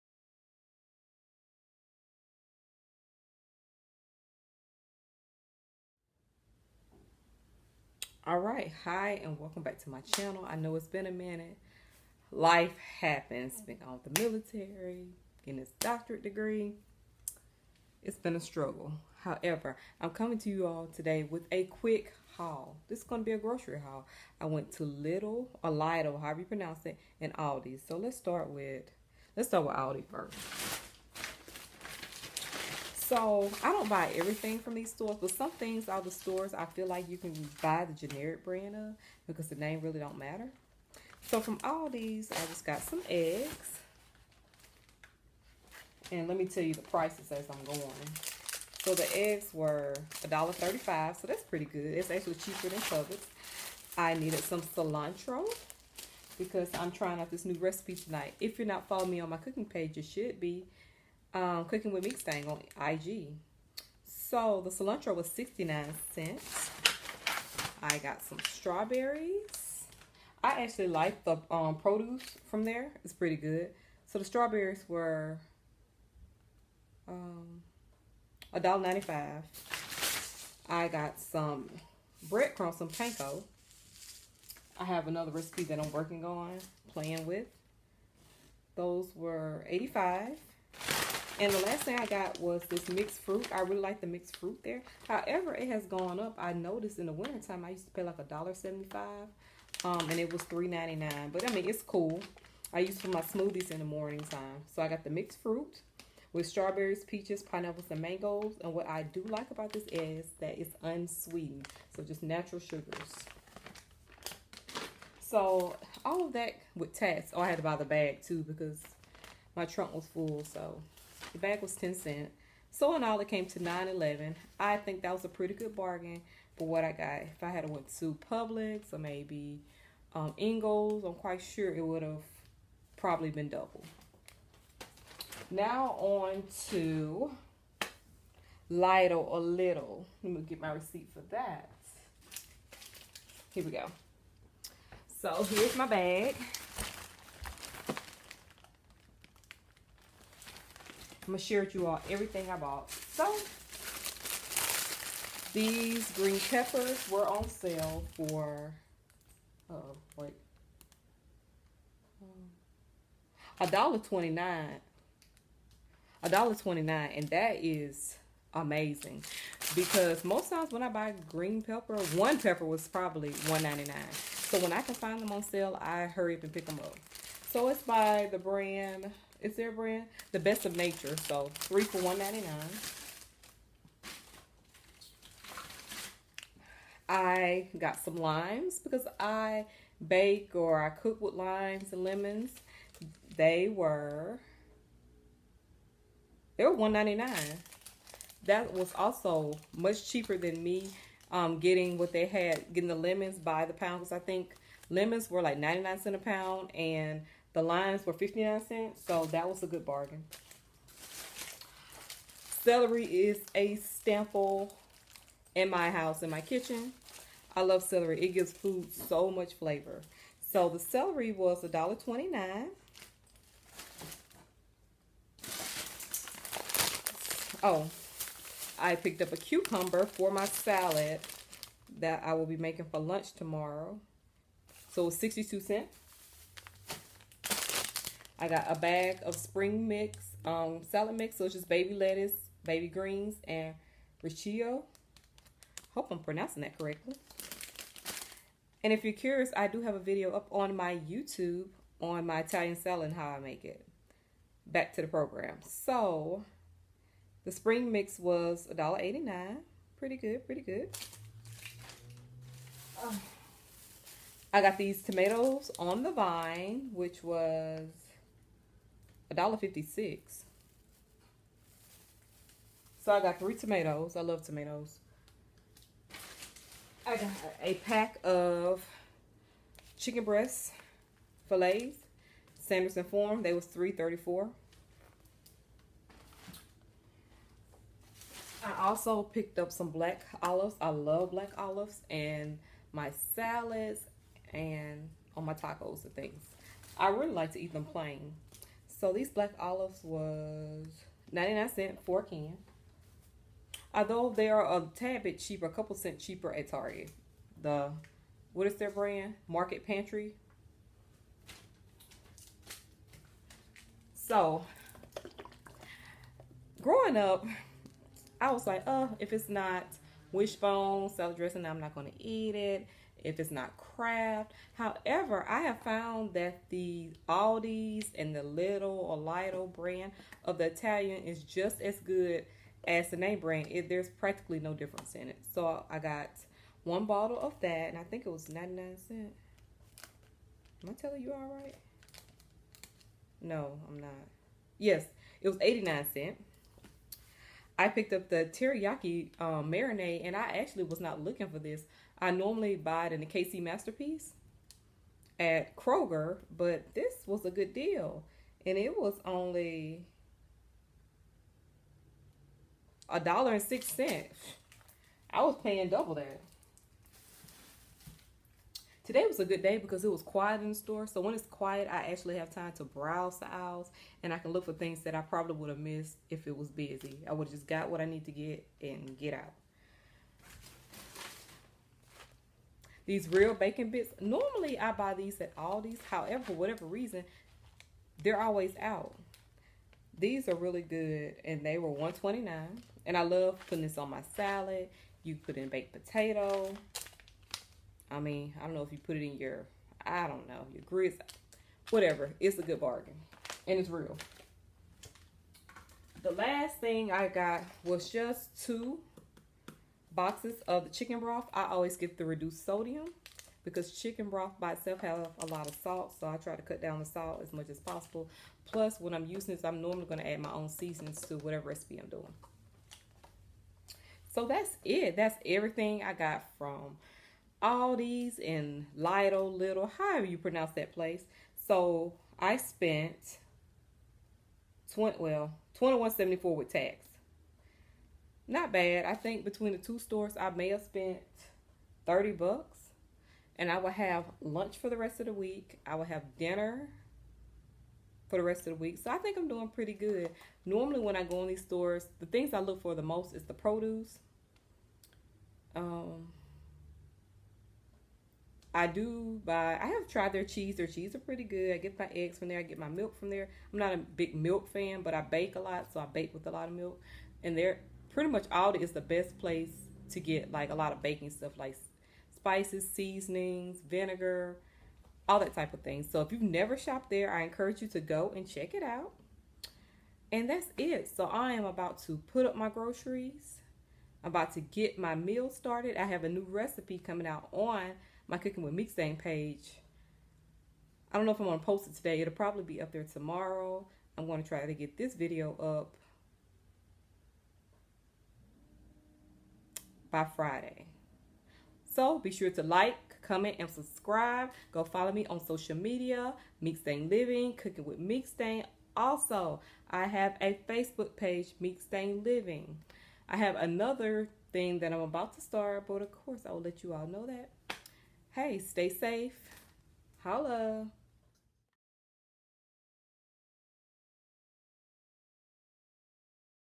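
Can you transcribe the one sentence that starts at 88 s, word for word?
Those were 85 and the last thing I got was this mixed fruit.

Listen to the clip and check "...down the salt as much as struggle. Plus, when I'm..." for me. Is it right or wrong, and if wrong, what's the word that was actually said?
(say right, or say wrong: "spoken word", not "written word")
wrong: "possible", not "struggle".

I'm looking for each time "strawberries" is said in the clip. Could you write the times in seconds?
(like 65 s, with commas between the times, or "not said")
68 s, 74 s, 106 s.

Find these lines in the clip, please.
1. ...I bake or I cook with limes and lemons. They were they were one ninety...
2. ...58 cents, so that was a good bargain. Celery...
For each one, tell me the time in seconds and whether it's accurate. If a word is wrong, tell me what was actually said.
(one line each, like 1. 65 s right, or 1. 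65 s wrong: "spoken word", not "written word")
1. 189 s right
2. 208 s wrong: "59", not "58".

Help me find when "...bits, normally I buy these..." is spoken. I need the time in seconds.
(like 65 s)
383 s.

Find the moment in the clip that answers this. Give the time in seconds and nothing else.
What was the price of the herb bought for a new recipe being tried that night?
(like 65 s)
65 s.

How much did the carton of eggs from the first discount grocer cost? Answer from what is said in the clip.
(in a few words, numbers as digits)
$1.35.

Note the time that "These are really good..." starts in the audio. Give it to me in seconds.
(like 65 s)
390 s.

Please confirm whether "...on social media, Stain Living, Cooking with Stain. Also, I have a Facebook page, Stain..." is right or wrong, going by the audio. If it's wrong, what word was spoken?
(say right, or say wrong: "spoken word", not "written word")
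right.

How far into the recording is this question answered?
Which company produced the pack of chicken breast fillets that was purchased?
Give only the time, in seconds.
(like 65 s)
282 s.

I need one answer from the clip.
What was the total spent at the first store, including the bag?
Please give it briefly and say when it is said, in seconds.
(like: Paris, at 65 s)
$9.11, at 123 s.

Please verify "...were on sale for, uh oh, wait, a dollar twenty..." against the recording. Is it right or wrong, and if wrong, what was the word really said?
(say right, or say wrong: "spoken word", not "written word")
right.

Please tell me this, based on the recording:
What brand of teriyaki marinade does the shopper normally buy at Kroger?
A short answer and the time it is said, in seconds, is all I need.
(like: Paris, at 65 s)
KC Masterpiece, at 353 s.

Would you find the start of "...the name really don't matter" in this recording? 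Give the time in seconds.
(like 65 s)
39 s.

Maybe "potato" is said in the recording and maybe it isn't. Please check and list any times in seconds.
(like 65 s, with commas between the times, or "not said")
395 s.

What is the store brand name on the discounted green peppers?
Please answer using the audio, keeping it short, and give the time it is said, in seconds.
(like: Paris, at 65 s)
The Best of Nature, at 180 s.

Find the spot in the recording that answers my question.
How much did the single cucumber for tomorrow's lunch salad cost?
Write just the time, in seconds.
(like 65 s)
235 s.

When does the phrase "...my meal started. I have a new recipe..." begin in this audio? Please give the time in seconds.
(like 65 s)
484 s.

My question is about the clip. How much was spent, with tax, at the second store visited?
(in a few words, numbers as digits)
$21.74.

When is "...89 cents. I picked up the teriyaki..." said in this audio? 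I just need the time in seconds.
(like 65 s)
345 s.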